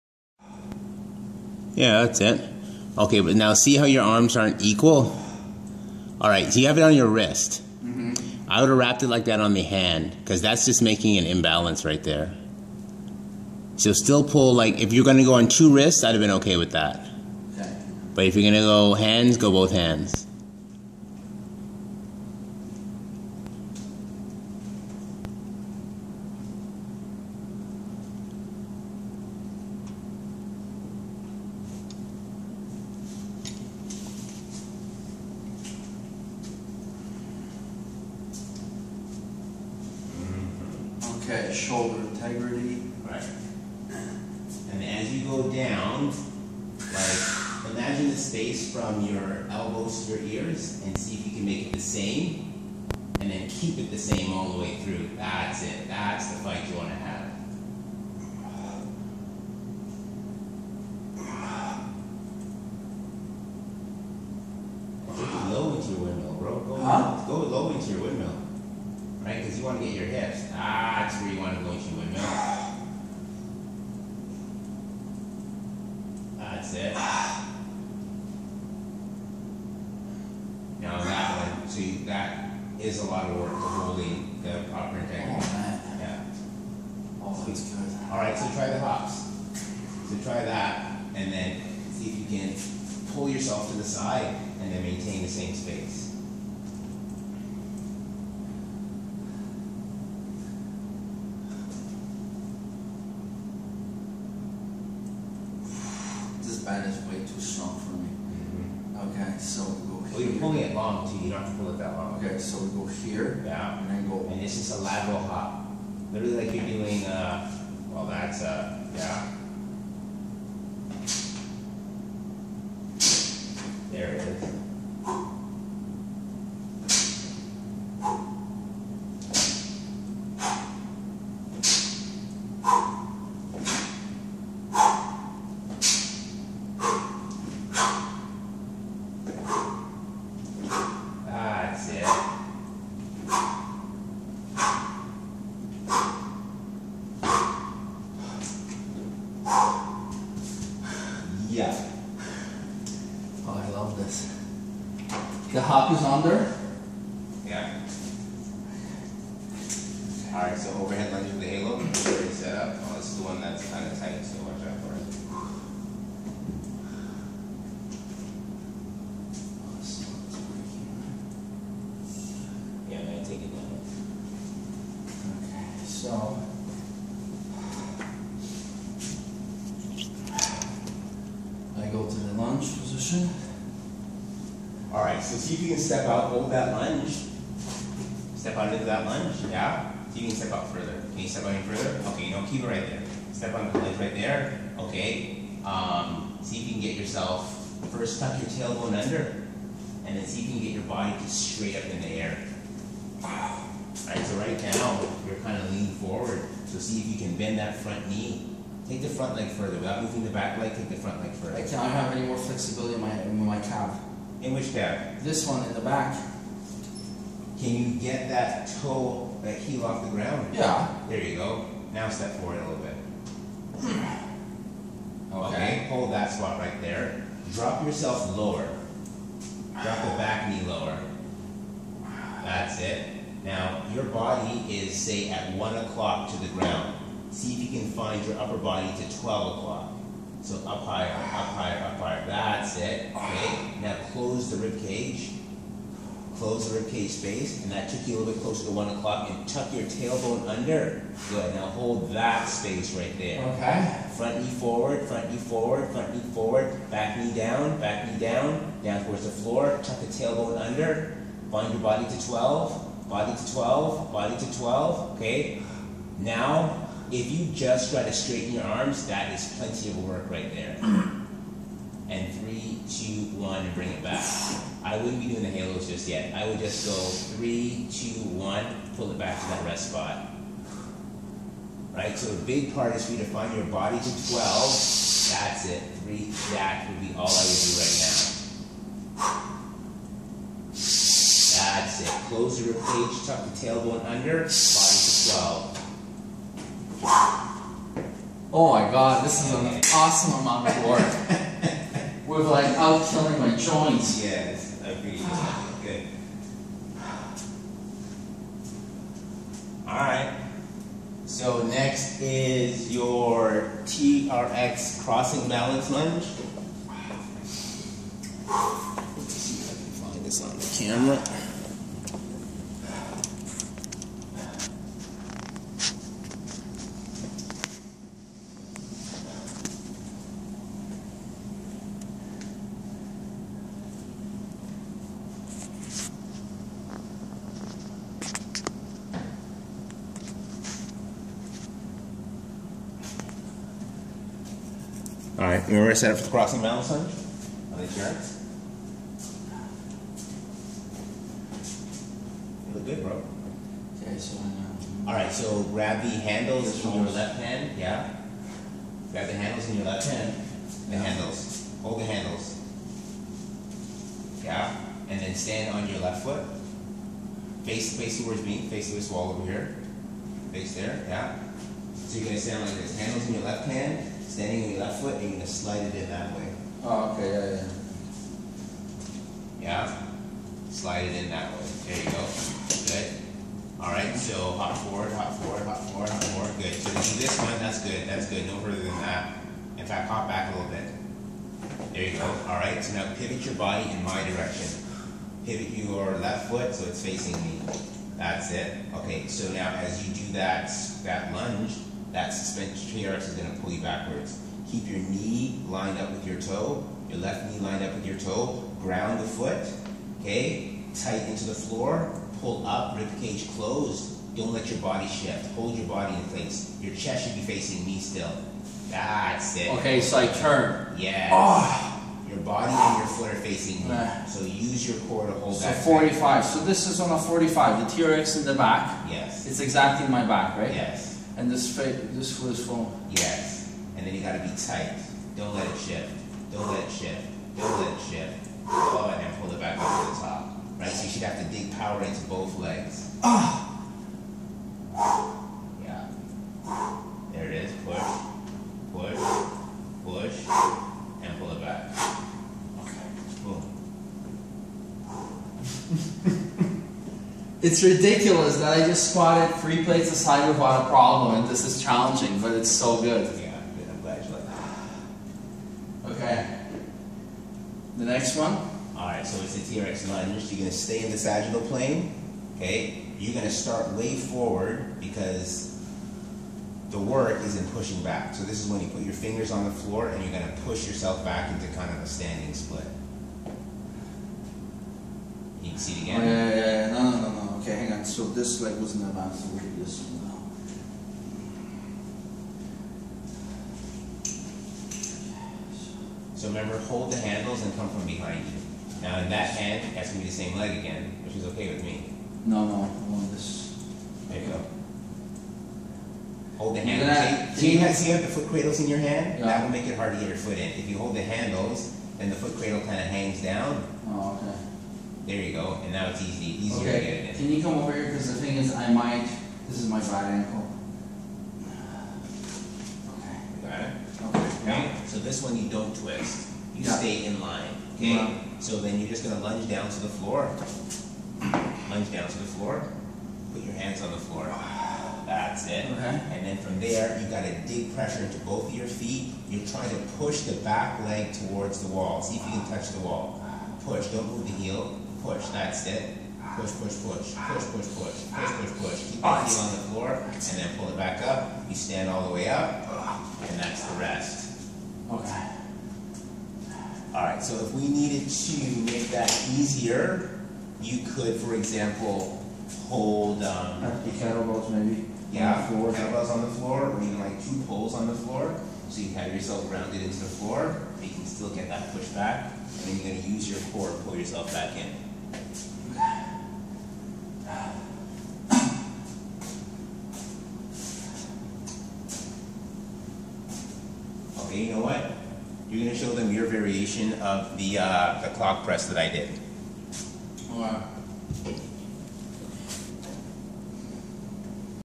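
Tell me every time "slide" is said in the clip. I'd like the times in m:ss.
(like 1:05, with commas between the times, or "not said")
6:15, 6:20.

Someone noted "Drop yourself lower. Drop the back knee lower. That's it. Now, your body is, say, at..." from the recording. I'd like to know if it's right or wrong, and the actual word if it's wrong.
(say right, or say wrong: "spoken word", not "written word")
right.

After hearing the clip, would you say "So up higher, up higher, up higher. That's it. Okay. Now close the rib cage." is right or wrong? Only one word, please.
right.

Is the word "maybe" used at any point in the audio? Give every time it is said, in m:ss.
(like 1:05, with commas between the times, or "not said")
9:24.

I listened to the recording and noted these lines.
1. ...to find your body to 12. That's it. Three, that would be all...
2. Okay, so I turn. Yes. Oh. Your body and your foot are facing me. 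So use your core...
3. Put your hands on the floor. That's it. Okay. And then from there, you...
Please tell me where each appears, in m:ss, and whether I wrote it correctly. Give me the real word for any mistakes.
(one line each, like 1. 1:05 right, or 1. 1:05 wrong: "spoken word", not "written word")
1. 4:43 right
2. 6:59 right
3. 8:53 right.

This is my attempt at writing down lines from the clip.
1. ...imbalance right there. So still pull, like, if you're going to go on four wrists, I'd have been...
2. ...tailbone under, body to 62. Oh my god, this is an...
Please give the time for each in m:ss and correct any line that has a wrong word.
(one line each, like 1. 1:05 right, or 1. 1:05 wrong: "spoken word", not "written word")
1. 0:11 wrong: "two", not "four"
2. 4:53 wrong: "12", not "62".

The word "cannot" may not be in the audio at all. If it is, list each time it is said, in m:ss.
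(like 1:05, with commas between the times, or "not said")
3:31.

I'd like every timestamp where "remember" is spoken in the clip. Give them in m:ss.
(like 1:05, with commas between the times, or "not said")
8:16.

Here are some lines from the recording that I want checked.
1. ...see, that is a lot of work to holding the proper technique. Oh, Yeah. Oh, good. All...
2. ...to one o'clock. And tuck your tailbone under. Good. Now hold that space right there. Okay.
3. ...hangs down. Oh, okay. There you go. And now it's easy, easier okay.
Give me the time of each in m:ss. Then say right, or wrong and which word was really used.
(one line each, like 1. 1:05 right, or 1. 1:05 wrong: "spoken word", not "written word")
1. 1:21 right
2. 4:08 right
3. 8:33 right.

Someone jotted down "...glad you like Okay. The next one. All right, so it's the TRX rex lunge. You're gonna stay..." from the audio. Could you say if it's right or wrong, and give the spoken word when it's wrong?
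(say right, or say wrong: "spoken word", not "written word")
right.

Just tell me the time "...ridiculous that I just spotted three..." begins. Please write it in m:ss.
7:37.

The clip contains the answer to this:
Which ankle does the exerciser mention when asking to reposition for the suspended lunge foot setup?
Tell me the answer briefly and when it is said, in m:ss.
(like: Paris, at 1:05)
right ankle, at 8:39.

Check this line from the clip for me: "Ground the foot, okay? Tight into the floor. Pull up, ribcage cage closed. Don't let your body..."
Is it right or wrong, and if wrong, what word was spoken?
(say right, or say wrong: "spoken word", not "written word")
right.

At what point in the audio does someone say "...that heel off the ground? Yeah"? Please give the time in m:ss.
3:39.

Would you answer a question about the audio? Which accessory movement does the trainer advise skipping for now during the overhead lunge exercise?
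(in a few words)
halos.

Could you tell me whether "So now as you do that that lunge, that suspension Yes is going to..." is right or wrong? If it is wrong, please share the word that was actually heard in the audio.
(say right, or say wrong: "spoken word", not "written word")
wrong: "TRX", not "Yes".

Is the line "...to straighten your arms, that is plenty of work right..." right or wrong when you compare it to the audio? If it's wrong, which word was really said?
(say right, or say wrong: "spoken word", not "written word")
right.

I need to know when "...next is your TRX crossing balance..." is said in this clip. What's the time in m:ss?
5:11.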